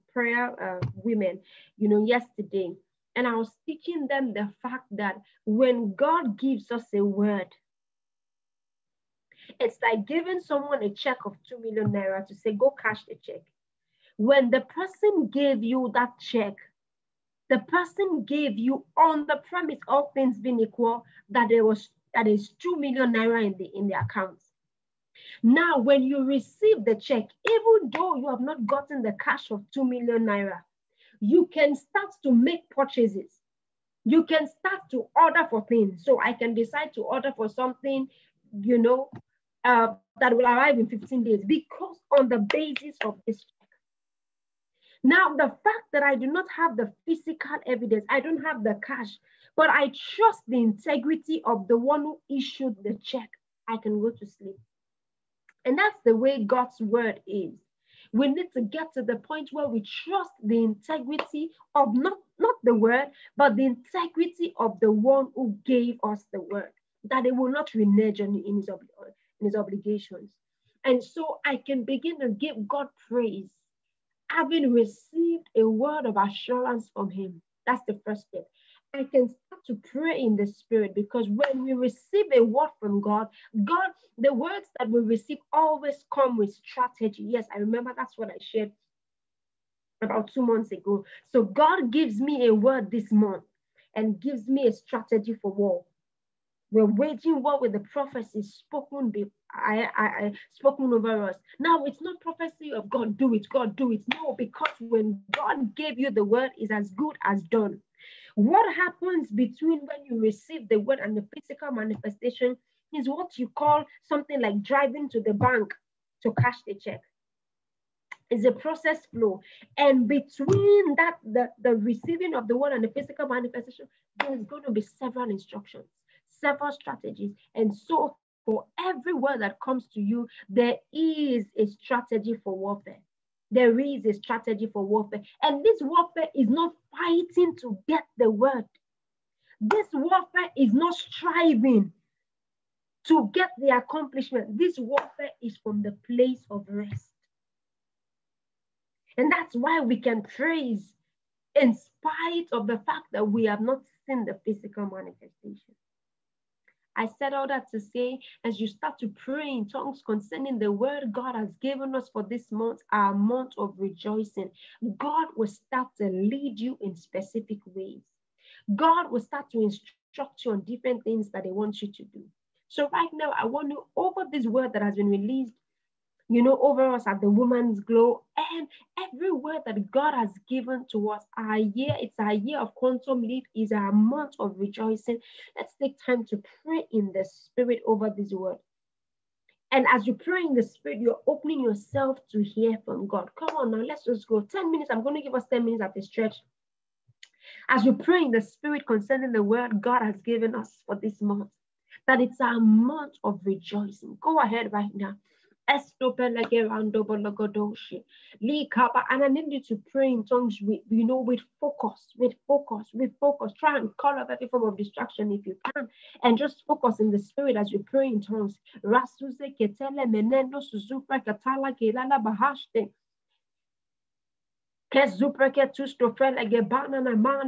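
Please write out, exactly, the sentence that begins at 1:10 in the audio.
And so I can begin to give God praise, having received a word of assurance from him.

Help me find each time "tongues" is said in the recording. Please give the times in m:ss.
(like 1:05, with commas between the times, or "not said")
2:39, 3:30, 3:38.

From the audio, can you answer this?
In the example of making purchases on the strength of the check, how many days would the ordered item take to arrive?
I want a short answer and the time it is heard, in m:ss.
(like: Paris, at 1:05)
15, at 0:40.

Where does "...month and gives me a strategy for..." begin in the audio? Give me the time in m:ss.
1:33.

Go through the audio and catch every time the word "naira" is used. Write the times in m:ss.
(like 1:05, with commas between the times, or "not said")
0:11, 0:23, 0:30.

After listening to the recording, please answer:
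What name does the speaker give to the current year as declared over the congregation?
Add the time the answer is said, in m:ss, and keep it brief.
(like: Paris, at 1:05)
year of quantum leap, at 3:02.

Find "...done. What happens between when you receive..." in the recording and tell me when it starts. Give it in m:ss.
1:47.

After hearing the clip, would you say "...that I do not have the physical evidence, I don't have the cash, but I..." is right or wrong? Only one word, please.
right.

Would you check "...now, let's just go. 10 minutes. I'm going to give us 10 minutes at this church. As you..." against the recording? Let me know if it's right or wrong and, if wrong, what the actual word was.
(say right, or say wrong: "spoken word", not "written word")
right.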